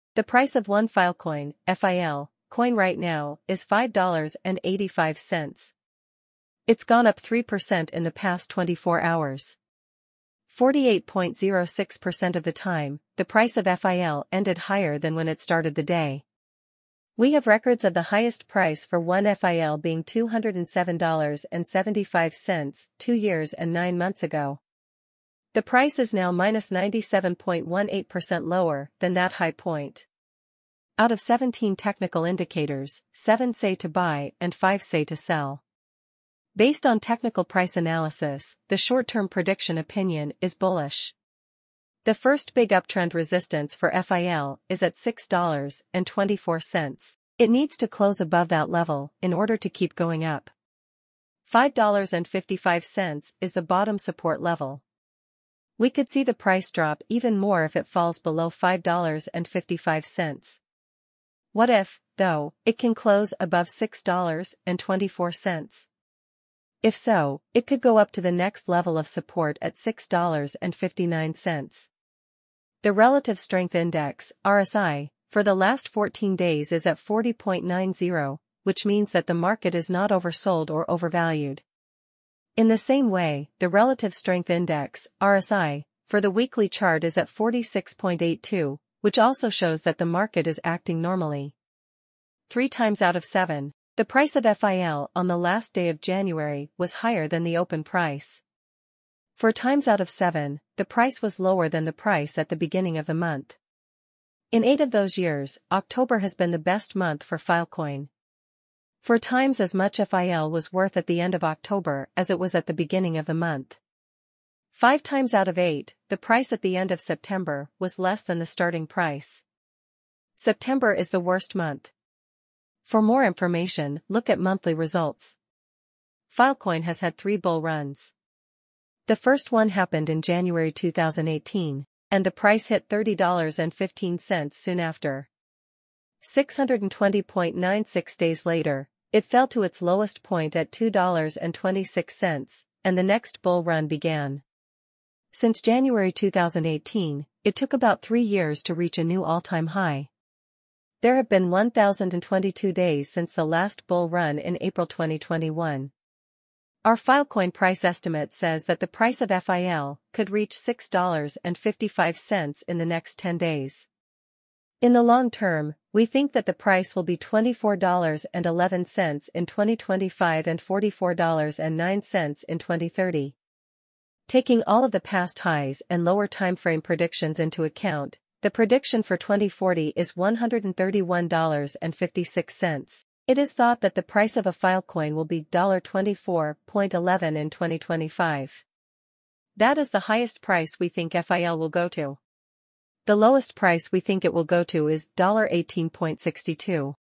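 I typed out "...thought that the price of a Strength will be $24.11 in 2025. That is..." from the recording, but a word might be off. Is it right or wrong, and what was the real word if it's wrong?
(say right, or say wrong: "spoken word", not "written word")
wrong: "Filecoin", not "Strength".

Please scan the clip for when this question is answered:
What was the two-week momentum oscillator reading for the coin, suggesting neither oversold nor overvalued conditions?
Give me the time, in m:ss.
1:16.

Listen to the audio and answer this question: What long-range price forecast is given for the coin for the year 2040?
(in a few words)
$131.56.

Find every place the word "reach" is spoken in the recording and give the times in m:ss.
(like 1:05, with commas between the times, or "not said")
2:28, 2:40.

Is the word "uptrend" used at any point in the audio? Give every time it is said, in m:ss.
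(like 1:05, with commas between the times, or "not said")
0:42.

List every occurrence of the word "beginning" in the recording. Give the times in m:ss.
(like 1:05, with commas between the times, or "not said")
1:42, 1:52.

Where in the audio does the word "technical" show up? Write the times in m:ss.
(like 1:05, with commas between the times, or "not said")
0:31, 0:37.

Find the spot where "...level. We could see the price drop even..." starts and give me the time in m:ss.
0:54.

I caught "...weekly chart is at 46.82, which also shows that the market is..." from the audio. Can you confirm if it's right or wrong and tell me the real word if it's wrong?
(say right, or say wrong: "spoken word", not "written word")
right.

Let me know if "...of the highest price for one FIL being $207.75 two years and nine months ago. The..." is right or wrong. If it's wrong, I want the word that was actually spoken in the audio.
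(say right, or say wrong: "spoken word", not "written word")
right.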